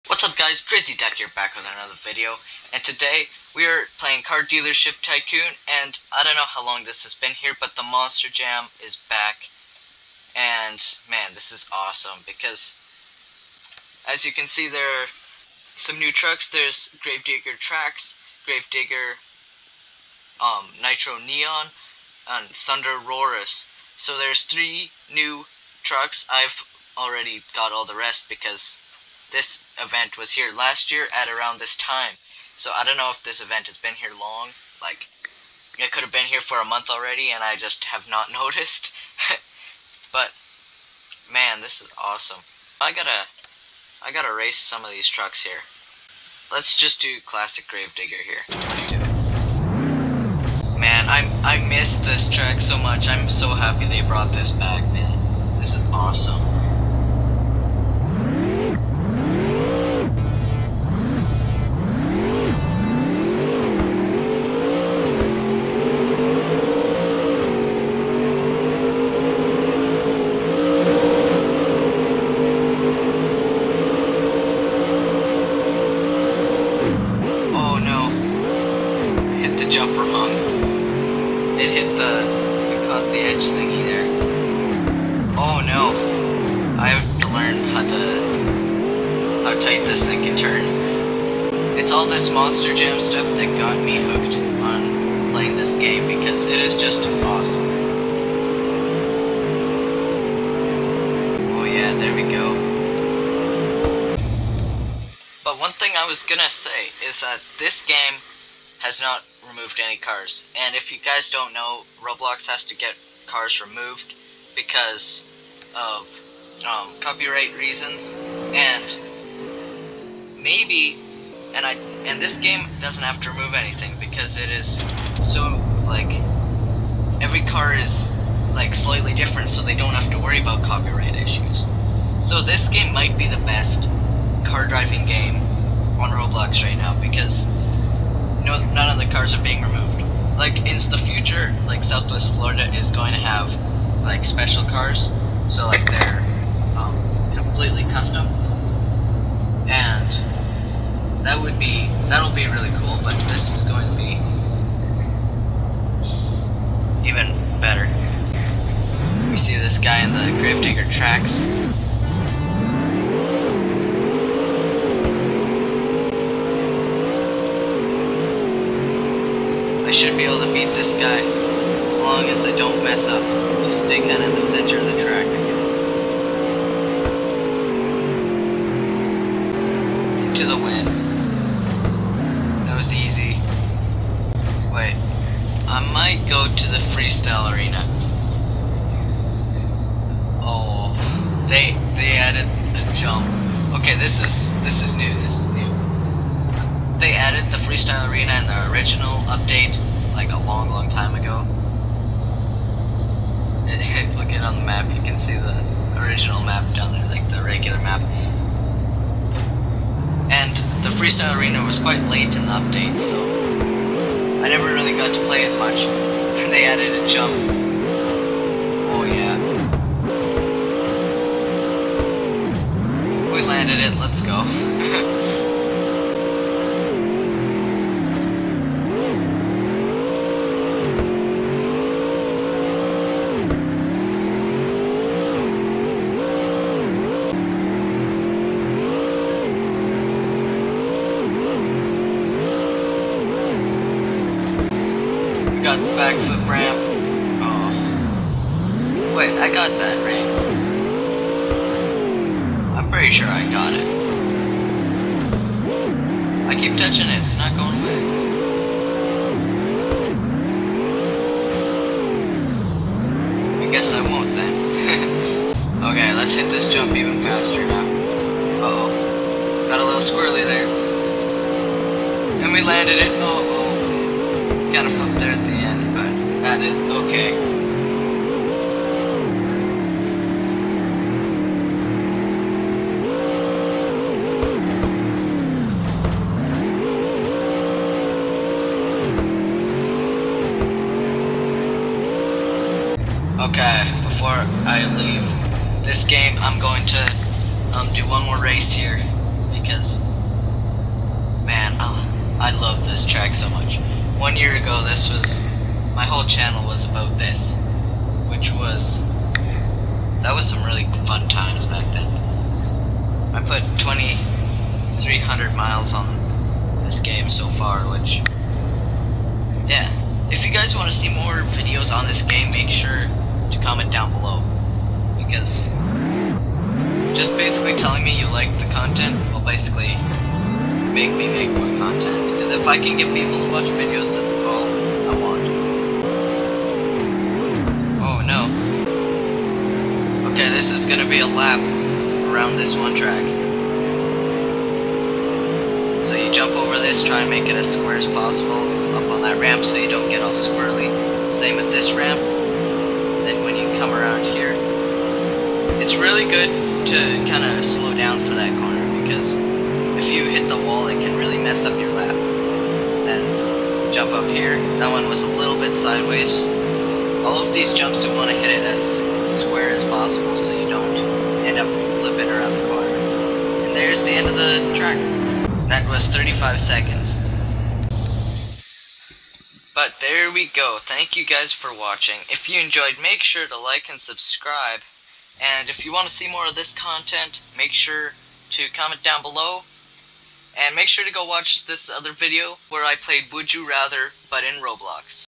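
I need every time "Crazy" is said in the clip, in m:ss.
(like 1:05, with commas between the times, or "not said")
0:00.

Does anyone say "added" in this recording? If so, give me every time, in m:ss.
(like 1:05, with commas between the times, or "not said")
3:12, 3:17, 3:36.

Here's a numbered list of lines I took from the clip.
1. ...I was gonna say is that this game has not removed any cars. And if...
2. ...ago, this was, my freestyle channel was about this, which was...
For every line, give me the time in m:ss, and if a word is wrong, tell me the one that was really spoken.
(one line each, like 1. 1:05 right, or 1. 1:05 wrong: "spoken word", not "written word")
1. 1:45 right
2. 5:04 wrong: "whole", not "freestyle".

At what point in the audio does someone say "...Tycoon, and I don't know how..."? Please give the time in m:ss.
0:05.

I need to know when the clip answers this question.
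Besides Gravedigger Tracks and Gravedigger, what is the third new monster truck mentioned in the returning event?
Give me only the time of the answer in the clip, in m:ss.
0:22.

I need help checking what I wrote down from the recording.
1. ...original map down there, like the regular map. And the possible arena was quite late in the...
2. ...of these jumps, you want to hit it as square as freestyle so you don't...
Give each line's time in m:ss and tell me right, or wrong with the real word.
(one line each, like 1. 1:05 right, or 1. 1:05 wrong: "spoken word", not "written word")
1. 3:26 wrong: "freestyle", not "possible"
2. 6:07 wrong: "possible", not "freestyle".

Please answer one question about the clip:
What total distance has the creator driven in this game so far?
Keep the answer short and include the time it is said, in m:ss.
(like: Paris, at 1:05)
2,300 miles, at 5:13.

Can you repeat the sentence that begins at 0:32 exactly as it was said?
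So I don't know if this event has been here long.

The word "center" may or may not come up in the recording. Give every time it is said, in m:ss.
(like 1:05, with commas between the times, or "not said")
2:54.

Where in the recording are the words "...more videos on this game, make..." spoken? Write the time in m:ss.
5:21.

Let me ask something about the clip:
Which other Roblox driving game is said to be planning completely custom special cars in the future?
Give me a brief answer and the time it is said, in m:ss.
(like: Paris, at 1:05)
Southwest Florida, at 2:21.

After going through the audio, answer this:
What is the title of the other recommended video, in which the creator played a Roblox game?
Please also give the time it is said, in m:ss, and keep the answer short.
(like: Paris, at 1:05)
Would You Rather, at 6:33.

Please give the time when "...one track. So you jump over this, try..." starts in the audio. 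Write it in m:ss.
5:42.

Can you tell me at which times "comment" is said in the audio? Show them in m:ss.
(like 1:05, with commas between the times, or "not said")
5:23, 6:28.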